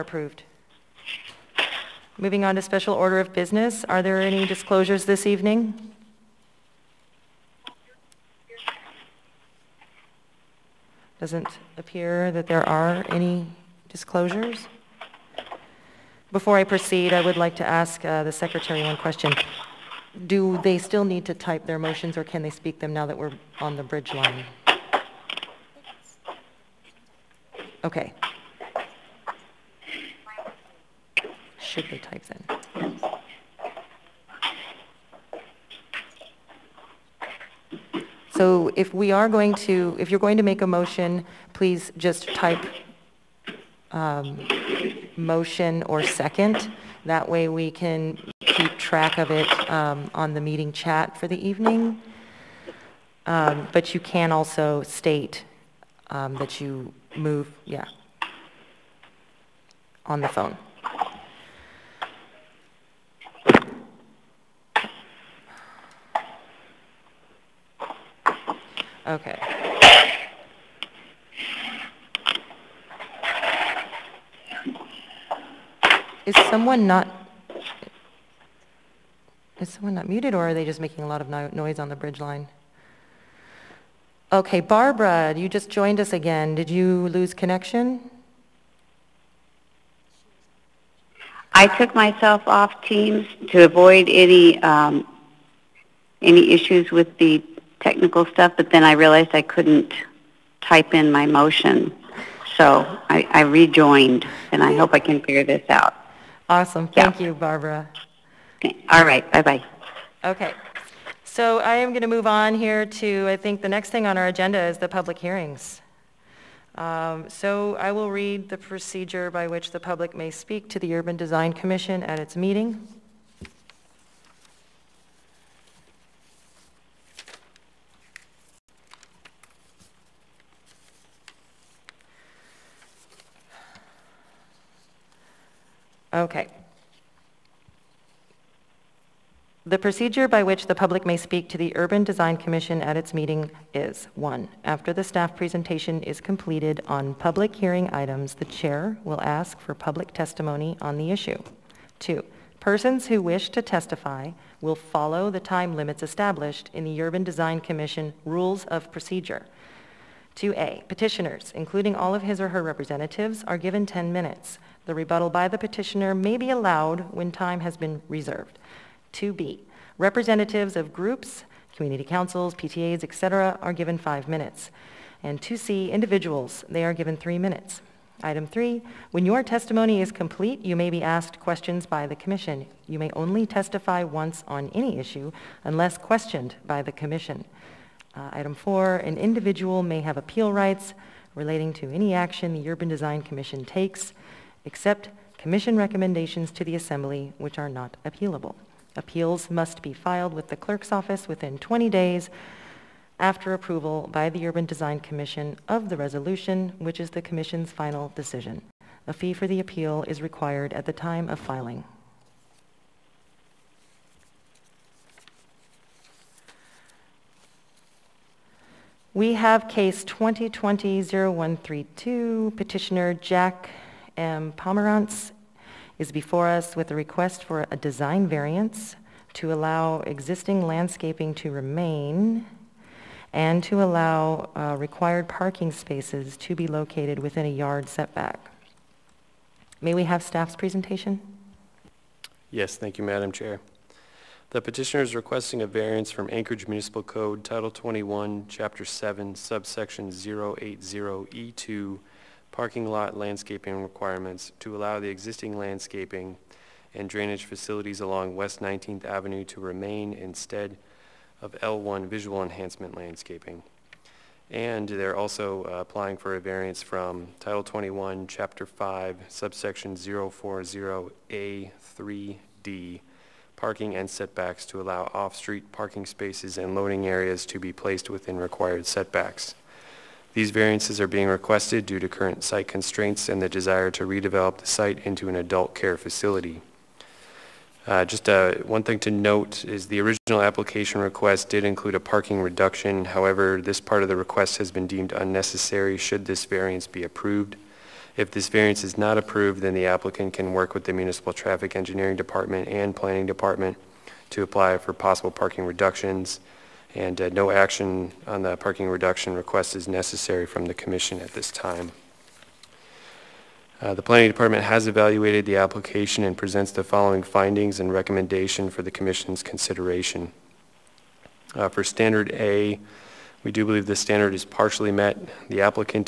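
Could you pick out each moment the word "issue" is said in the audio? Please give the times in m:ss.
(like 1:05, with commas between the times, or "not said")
1:36, 2:31, 3:04.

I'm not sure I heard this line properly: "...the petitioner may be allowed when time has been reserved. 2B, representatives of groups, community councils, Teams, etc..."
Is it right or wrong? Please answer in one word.
wrong.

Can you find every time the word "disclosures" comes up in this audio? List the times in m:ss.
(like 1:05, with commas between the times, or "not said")
0:04, 0:13.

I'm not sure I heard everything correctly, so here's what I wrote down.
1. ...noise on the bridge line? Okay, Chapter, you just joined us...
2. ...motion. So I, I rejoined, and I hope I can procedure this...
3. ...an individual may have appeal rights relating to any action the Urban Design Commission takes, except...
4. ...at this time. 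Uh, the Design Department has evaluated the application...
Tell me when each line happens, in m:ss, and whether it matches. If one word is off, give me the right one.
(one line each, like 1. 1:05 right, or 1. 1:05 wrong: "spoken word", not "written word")
1. 1:21 wrong: "Barbara", not "Chapter"
2. 1:41 wrong: "figure", not "procedure"
3. 3:08 right
4. 5:11 wrong: "Planning", not "Design".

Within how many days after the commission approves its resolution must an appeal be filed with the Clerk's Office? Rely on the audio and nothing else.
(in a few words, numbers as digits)
20 days.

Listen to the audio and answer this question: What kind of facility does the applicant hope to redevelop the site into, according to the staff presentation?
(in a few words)
adult care facility.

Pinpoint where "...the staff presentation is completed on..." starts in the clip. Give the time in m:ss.
2:24.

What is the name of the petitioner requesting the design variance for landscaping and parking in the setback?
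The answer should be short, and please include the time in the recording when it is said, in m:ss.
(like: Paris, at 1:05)
Jack M. Pomerantz, at 3:43.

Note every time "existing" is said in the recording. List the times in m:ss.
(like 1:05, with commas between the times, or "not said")
3:50, 4:15.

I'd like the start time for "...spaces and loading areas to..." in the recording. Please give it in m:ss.
4:36.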